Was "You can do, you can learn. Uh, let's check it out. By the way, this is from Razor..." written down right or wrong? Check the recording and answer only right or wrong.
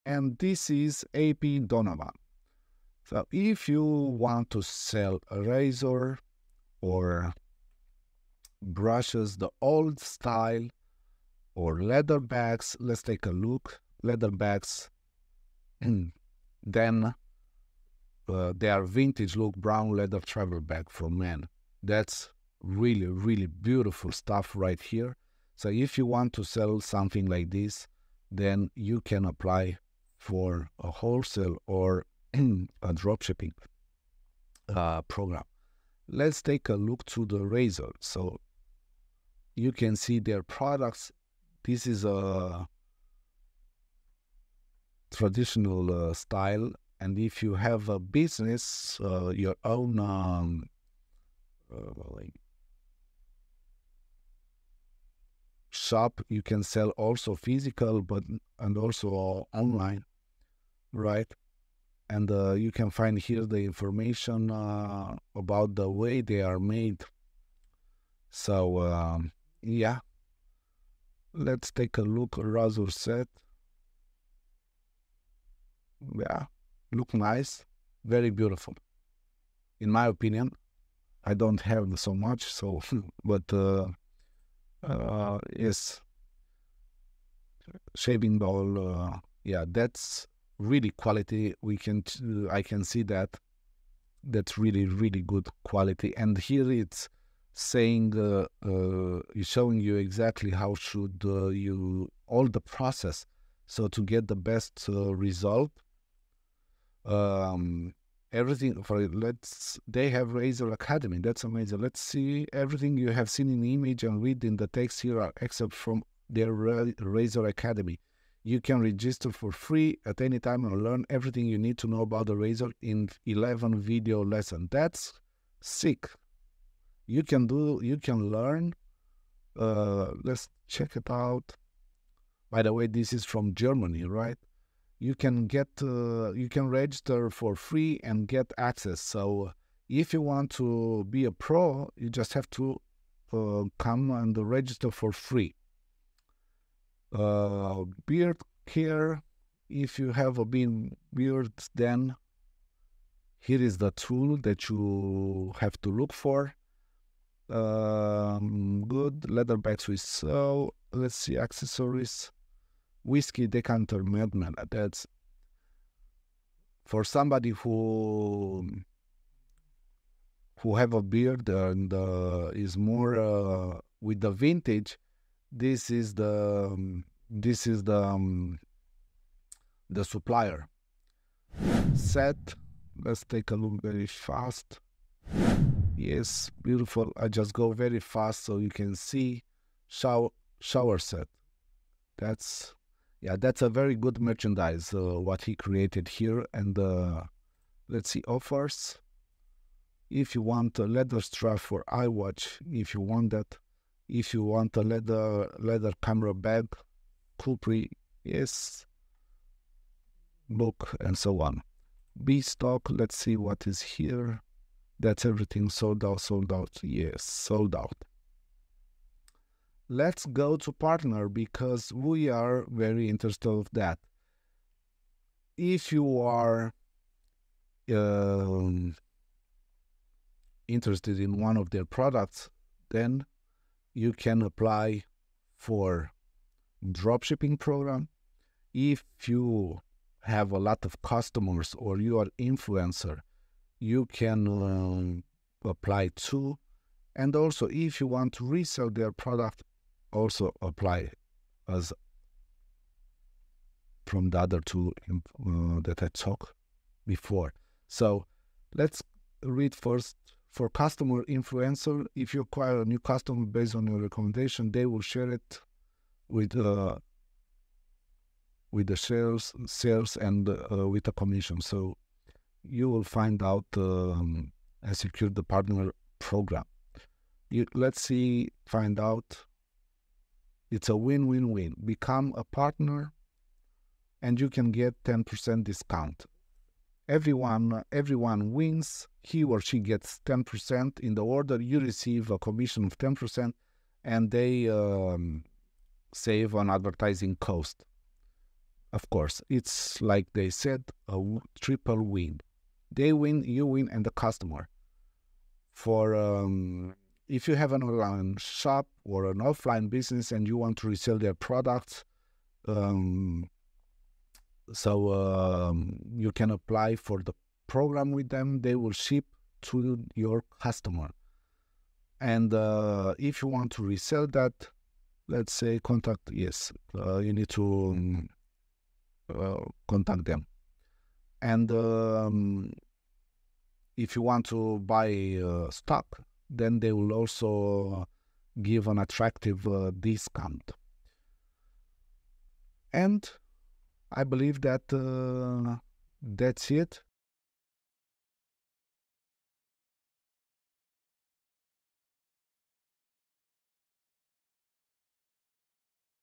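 wrong.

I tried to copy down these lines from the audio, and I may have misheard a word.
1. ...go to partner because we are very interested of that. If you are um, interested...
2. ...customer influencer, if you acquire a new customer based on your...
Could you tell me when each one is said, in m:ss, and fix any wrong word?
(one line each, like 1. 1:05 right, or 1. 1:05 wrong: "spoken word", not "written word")
1. 3:40 right
2. 4:20 right.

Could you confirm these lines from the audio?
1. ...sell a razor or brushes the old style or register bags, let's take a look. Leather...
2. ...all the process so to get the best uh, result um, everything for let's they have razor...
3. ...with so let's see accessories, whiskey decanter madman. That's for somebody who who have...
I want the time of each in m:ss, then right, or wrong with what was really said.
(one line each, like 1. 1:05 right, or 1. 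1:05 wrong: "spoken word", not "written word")
1. 0:04 wrong: "leather", not "register"
2. 1:42 right
3. 2:39 right.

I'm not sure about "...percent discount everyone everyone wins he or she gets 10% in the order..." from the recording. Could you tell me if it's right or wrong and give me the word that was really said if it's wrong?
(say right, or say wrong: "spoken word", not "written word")
right.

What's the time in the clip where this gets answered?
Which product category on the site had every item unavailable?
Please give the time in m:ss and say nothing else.
3:32.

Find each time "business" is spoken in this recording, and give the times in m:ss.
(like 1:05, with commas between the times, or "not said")
0:47, 5:09.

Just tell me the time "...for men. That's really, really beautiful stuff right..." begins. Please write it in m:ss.
0:20.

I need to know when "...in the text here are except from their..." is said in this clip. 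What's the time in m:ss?
1:54.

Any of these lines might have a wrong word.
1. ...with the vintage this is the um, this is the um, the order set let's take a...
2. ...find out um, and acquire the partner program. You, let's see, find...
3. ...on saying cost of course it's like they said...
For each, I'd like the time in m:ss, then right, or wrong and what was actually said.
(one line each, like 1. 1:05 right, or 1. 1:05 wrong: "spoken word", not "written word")
1. 2:53 wrong: "supplier", not "order"
2. 4:33 wrong: "secure", not "acquire"
3. 4:56 wrong: "advertising", not "saying".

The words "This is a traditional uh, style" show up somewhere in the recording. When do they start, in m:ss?
0:41.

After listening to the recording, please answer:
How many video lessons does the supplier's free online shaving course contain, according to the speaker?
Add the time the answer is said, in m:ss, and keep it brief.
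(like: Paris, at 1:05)
11, at 2:03.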